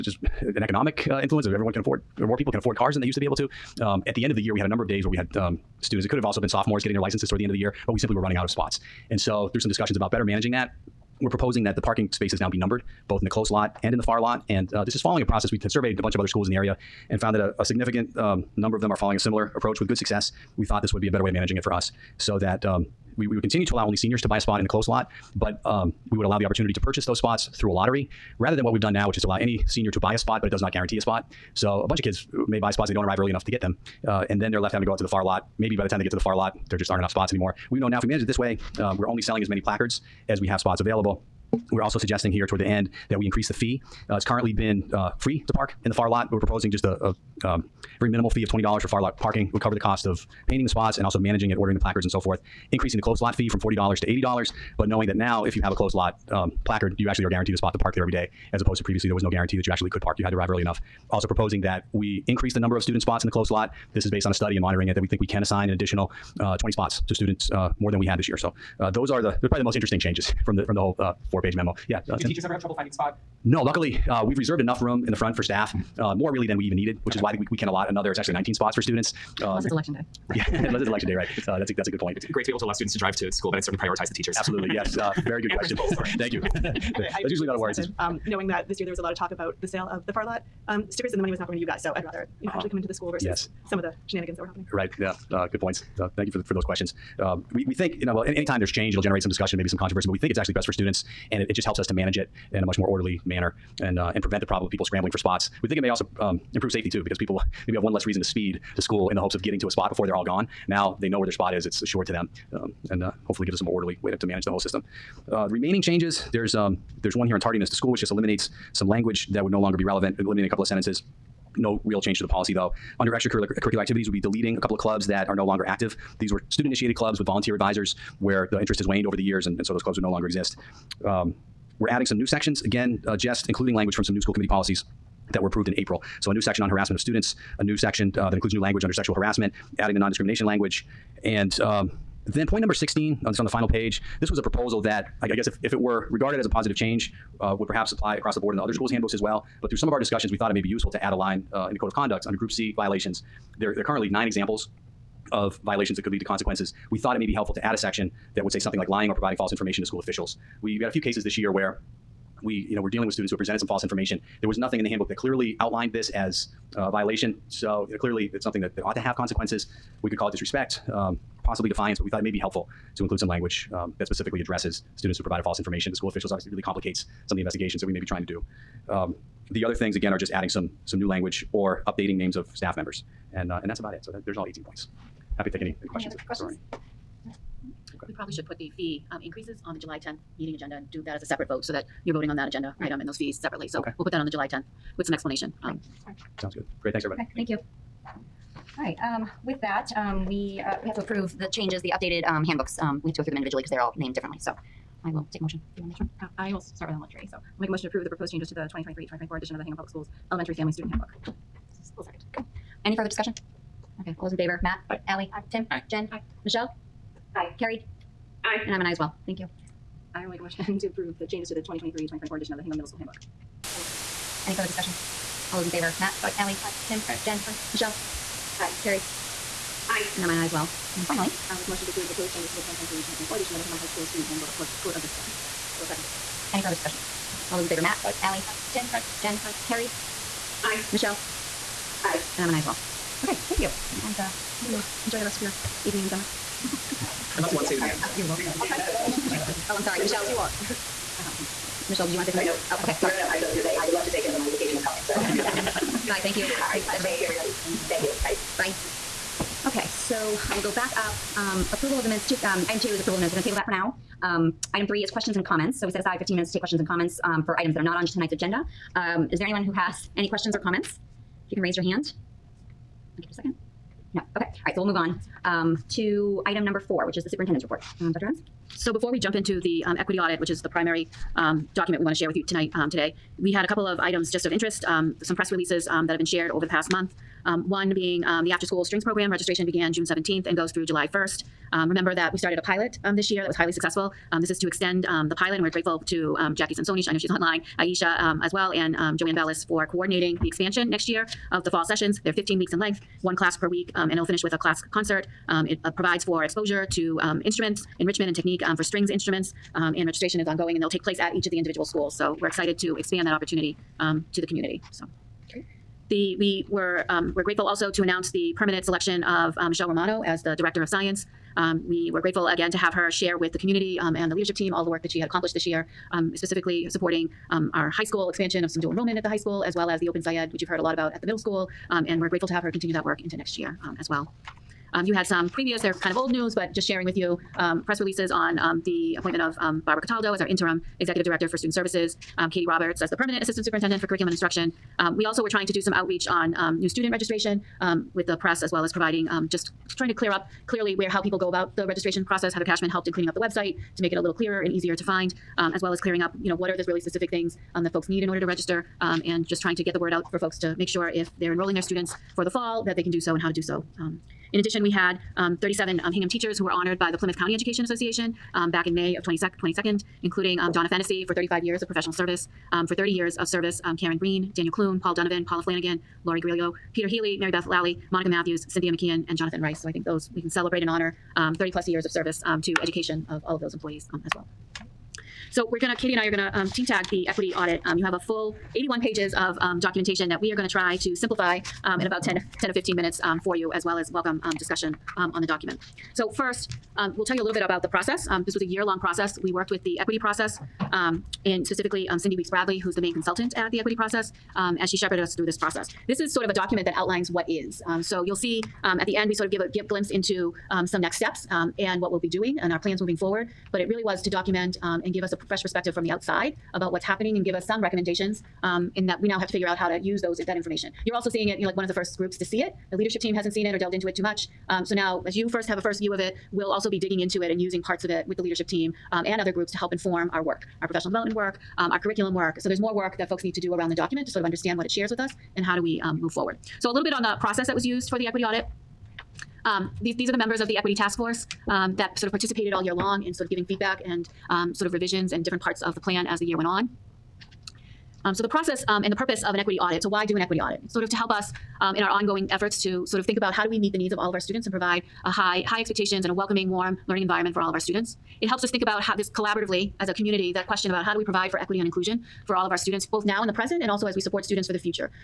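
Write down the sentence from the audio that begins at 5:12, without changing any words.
So we're excited to expand that opportunity um, to the community.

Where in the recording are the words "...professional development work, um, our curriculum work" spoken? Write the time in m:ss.
7:10.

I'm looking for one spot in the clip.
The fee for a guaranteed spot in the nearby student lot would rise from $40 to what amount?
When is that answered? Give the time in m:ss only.
0:54.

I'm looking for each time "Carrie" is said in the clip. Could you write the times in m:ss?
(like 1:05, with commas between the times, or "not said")
3:37, 3:48, 3:59.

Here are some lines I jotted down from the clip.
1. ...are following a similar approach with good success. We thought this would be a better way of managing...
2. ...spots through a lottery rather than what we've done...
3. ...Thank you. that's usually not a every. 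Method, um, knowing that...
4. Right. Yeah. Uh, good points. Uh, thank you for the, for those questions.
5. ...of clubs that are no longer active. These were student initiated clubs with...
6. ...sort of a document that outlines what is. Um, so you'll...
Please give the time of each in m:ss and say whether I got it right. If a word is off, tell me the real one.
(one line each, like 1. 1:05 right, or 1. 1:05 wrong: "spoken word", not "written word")
1. 0:18 right
2. 0:27 right
3. 1:26 wrong: "worry", not "every"
4. 1:34 right
5. 2:04 right
6. 6:46 right.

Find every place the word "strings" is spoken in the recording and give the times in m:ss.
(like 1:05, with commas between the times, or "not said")
4:48, 5:08.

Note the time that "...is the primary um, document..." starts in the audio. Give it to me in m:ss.
4:40.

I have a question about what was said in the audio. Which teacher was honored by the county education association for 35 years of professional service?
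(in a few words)
Donna Fennessy.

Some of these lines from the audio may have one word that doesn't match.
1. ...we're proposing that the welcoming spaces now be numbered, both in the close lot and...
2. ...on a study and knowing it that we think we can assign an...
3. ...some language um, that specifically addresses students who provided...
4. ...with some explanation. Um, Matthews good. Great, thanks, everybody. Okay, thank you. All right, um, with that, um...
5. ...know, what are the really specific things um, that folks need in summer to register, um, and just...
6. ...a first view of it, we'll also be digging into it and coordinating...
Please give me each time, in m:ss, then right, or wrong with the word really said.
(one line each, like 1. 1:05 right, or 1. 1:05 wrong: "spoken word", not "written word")
1. 0:11 wrong: "parking", not "welcoming"
2. 1:04 wrong: "monitoring", not "knowing"
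3. 2:53 right
4. 3:14 wrong: "Sounds", not "Matthews"
5. 5:56 wrong: "order", not "summer"
6. 7:05 wrong: "using", not "coordinating".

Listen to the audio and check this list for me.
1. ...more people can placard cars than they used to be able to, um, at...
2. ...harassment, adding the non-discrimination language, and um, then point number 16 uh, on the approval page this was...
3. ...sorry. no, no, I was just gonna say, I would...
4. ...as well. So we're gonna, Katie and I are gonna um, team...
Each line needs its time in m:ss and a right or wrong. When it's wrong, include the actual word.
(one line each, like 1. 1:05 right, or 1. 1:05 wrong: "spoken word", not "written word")
1. 0:02 wrong: "afford", not "placard"
2. 2:19 wrong: "final", not "approval"
3. 4:13 right
4. 6:24 right.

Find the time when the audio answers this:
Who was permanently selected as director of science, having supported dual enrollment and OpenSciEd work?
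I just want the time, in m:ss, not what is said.
5:19.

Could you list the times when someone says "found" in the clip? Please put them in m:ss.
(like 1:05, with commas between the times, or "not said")
0:17.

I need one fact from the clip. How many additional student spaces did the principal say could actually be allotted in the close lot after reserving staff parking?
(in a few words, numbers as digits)
19.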